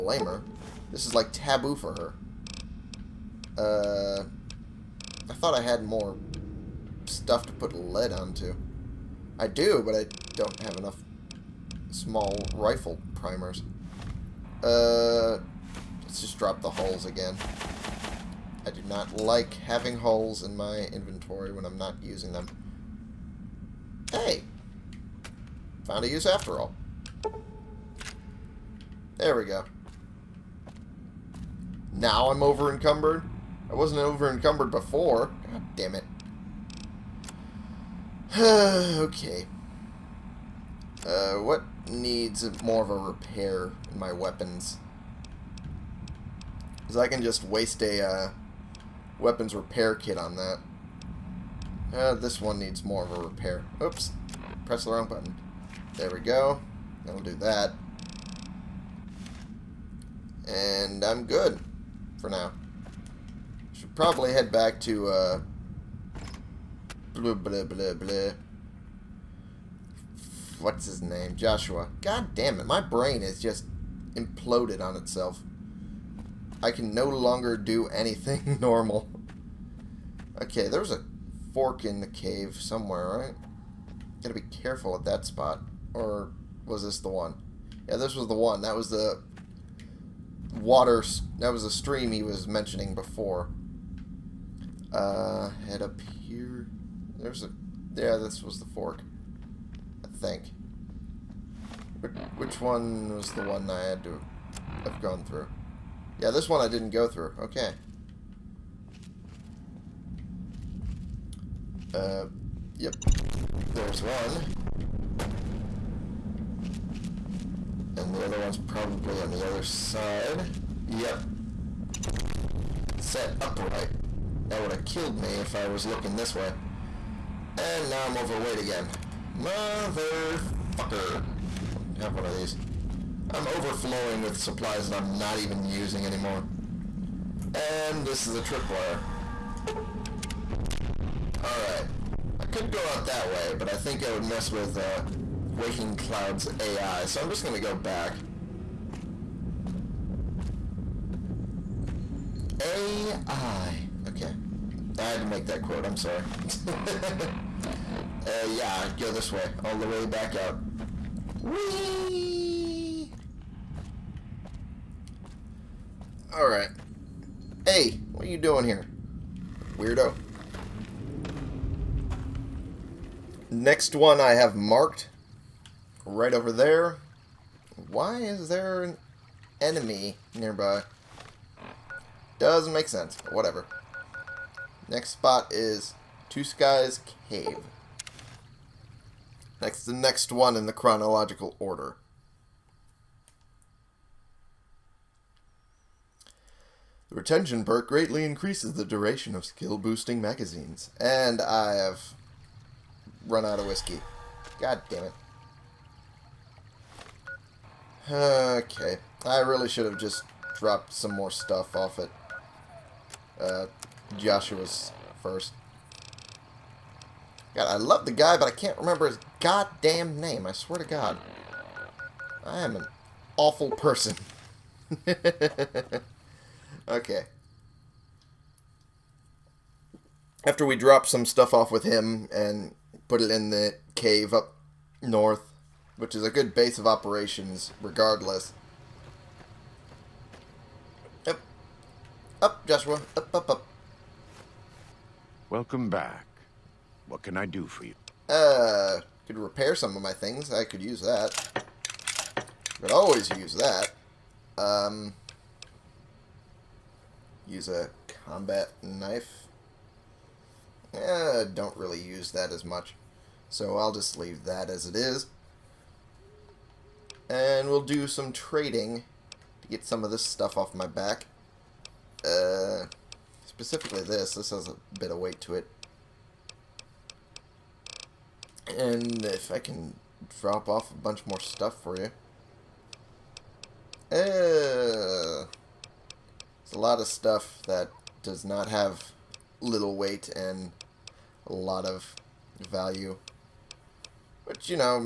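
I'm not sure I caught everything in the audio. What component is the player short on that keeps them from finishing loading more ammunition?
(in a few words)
small rifle primers.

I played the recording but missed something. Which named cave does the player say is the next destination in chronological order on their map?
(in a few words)
Two Skies Cave.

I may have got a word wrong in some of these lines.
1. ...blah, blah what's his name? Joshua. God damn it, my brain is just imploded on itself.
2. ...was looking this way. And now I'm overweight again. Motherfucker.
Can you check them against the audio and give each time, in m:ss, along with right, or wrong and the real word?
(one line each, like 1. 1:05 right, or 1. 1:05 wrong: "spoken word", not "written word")
1. 1:07 right
2. 2:05 right.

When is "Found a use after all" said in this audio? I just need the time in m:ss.
0:25.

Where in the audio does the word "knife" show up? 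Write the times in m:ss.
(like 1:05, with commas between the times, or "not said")
4:18.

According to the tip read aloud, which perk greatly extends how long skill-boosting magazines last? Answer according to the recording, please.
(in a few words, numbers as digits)
retention.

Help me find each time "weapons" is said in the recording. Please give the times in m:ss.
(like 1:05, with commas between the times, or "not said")
0:44, 0:49.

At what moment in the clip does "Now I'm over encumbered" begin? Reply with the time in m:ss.
0:31.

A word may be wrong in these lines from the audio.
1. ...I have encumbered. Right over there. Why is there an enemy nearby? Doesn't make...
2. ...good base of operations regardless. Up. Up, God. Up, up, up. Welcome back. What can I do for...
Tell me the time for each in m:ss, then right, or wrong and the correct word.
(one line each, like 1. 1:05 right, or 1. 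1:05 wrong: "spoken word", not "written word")
1. 2:54 wrong: "marked", not "encumbered"
2. 3:56 wrong: "Joshua", not "God".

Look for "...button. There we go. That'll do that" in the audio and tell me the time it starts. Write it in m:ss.
0:55.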